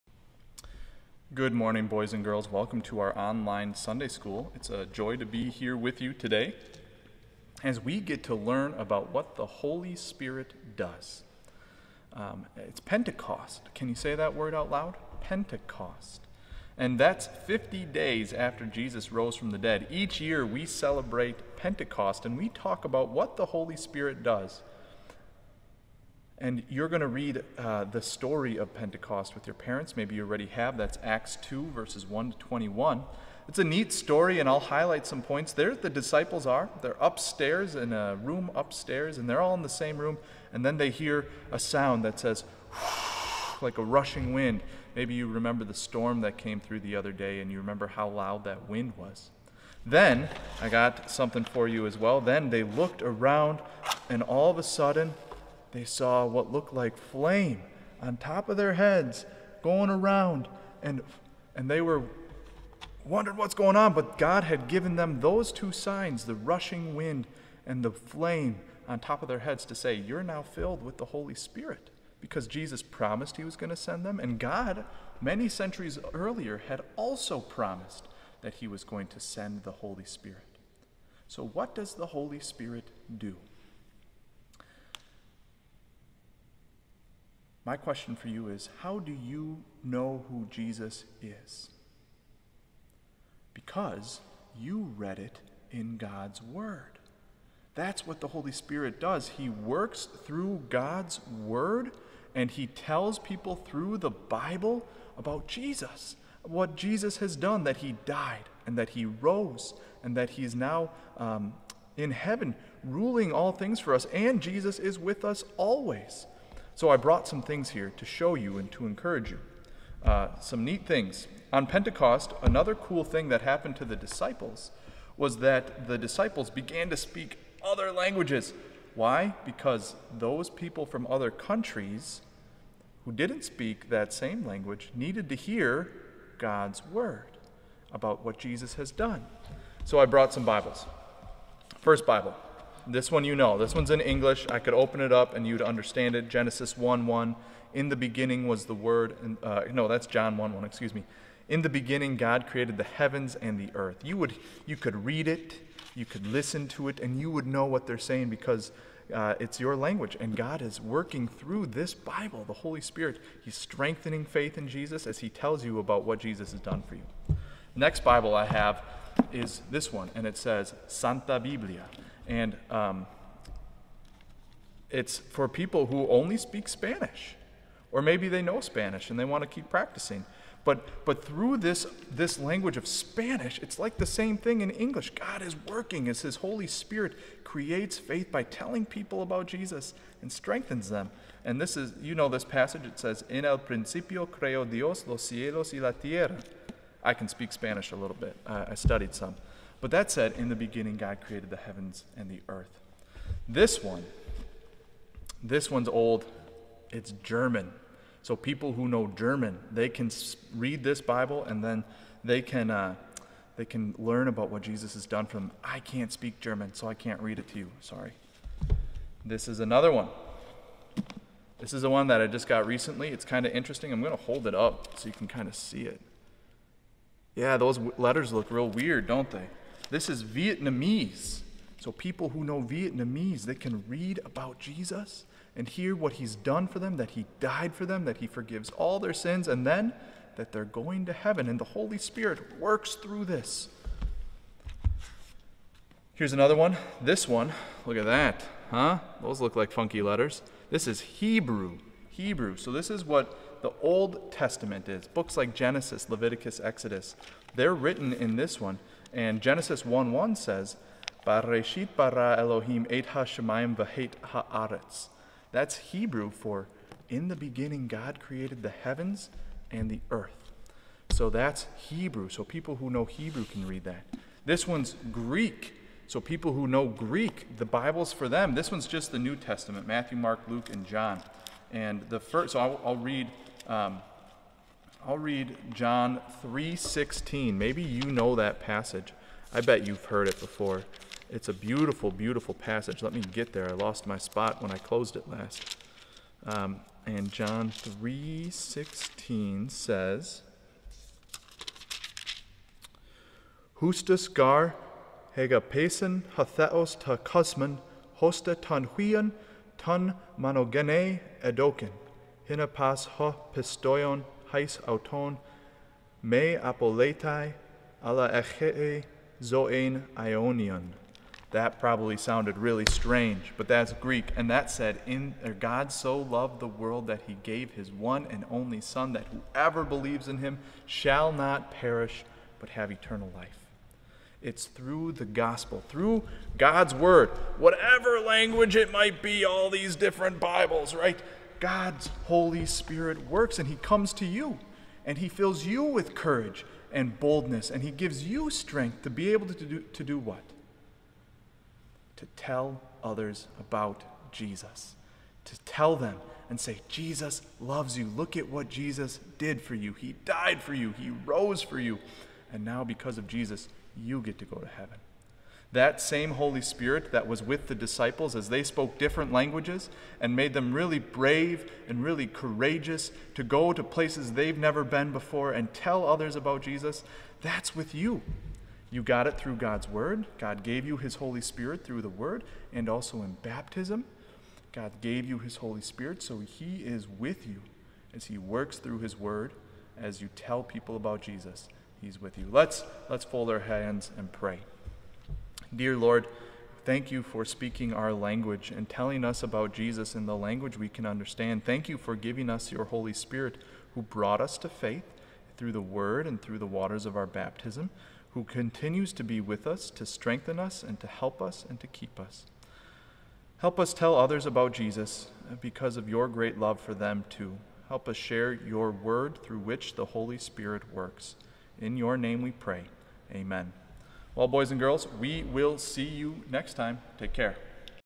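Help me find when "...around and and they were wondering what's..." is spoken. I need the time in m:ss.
0:59.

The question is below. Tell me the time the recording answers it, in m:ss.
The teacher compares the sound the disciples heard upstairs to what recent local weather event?
0:45.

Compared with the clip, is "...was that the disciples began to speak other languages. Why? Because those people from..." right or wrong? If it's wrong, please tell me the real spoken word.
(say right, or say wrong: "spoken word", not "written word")
right.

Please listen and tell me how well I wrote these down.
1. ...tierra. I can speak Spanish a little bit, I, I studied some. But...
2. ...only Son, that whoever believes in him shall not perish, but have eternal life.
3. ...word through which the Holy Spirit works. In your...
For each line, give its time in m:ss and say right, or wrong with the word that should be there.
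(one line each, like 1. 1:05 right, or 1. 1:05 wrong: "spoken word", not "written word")
1. 3:15 right
2. 5:28 right
3. 6:58 right.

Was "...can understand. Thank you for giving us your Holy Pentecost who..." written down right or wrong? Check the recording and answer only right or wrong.
wrong.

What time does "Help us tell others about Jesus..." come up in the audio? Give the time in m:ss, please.
6:53.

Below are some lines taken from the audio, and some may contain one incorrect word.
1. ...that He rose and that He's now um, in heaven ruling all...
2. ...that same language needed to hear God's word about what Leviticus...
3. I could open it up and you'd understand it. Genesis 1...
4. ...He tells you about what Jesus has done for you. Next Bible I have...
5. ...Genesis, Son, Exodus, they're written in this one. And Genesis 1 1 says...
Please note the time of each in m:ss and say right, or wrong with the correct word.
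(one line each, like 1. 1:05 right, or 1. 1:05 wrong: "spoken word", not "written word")
1. 1:48 right
2. 2:13 wrong: "Jesus", not "Leviticus"
3. 2:24 right
4. 2:45 right
5. 4:15 wrong: "Leviticus", not "Son".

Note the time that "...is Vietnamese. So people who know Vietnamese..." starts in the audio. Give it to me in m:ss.
3:50.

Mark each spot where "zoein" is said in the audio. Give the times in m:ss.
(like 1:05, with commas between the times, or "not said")
5:18.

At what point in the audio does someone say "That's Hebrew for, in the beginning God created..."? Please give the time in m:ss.
4:25.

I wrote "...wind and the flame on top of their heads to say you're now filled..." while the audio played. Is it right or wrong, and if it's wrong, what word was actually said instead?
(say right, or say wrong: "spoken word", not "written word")
right.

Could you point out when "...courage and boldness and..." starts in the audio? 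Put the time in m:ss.
5:46.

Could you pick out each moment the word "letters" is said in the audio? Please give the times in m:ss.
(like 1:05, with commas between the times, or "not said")
3:47, 4:10.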